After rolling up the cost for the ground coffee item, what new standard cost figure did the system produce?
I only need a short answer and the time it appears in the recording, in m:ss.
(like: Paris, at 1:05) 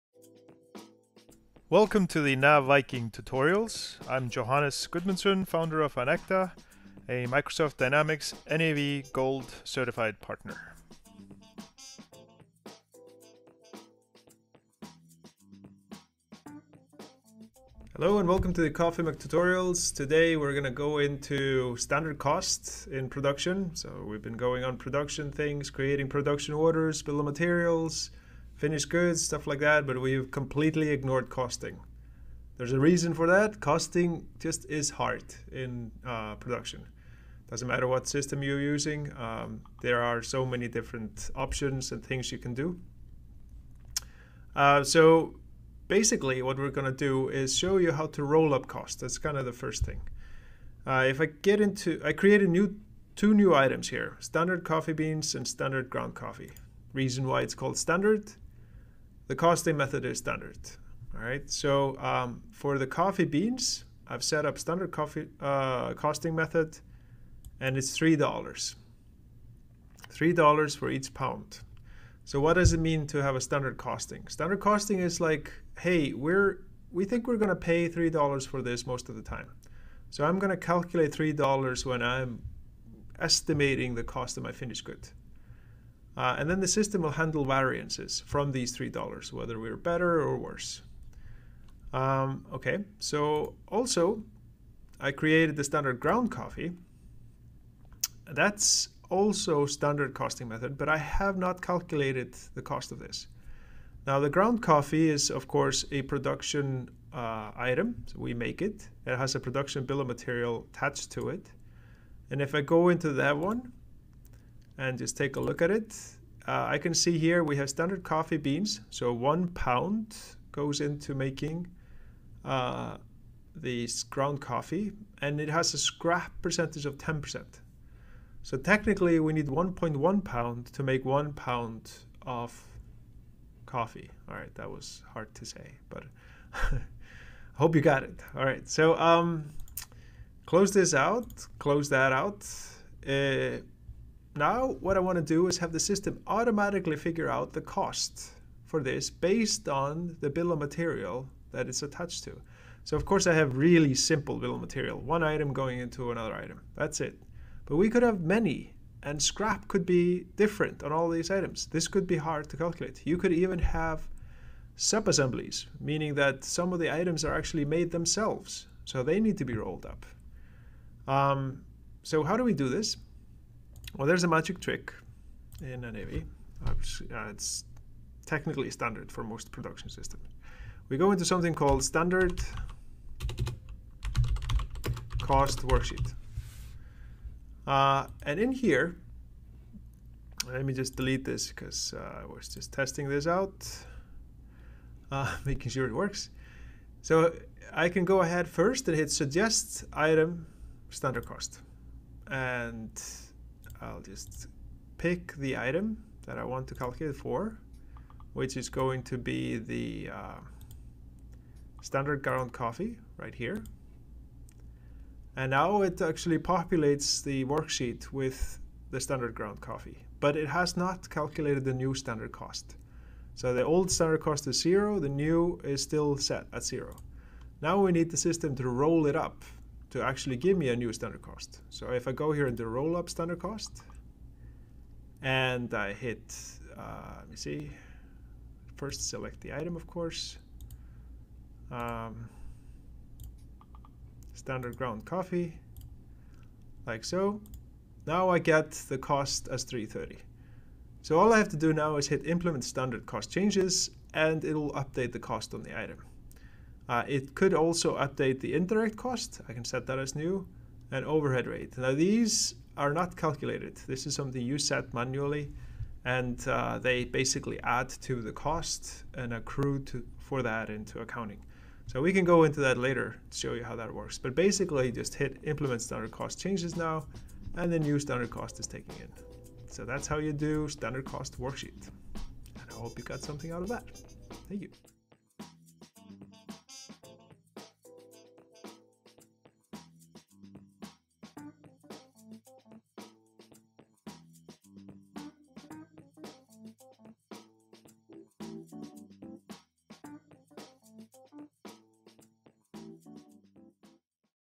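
3.30, at 4:09.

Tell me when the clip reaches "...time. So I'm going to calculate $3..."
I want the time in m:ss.
1:19.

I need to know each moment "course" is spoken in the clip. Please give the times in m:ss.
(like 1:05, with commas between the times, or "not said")
1:45, 2:33, 3:59.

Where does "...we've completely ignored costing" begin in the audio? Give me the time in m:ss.
0:29.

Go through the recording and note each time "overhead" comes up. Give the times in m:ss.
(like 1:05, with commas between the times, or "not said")
4:21.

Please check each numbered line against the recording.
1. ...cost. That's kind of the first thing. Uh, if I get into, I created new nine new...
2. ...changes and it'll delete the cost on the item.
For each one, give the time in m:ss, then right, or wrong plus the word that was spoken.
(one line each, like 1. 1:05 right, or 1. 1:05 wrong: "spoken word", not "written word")
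1. 0:48 wrong: "two", not "nine"
2. 4:13 wrong: "update", not "delete".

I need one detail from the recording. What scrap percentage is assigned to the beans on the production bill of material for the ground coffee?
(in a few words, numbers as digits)
10%.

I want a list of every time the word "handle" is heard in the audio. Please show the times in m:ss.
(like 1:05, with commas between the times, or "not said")
1:27.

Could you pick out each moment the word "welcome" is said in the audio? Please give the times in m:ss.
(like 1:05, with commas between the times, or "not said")
0:01, 0:18.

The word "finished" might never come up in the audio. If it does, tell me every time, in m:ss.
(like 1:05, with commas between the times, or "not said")
0:28, 1:24.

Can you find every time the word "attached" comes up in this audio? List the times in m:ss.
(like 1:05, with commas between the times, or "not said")
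1:50, 2:31.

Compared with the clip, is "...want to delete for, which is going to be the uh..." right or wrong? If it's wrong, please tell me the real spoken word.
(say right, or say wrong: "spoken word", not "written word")
wrong: "calculate", not "delete".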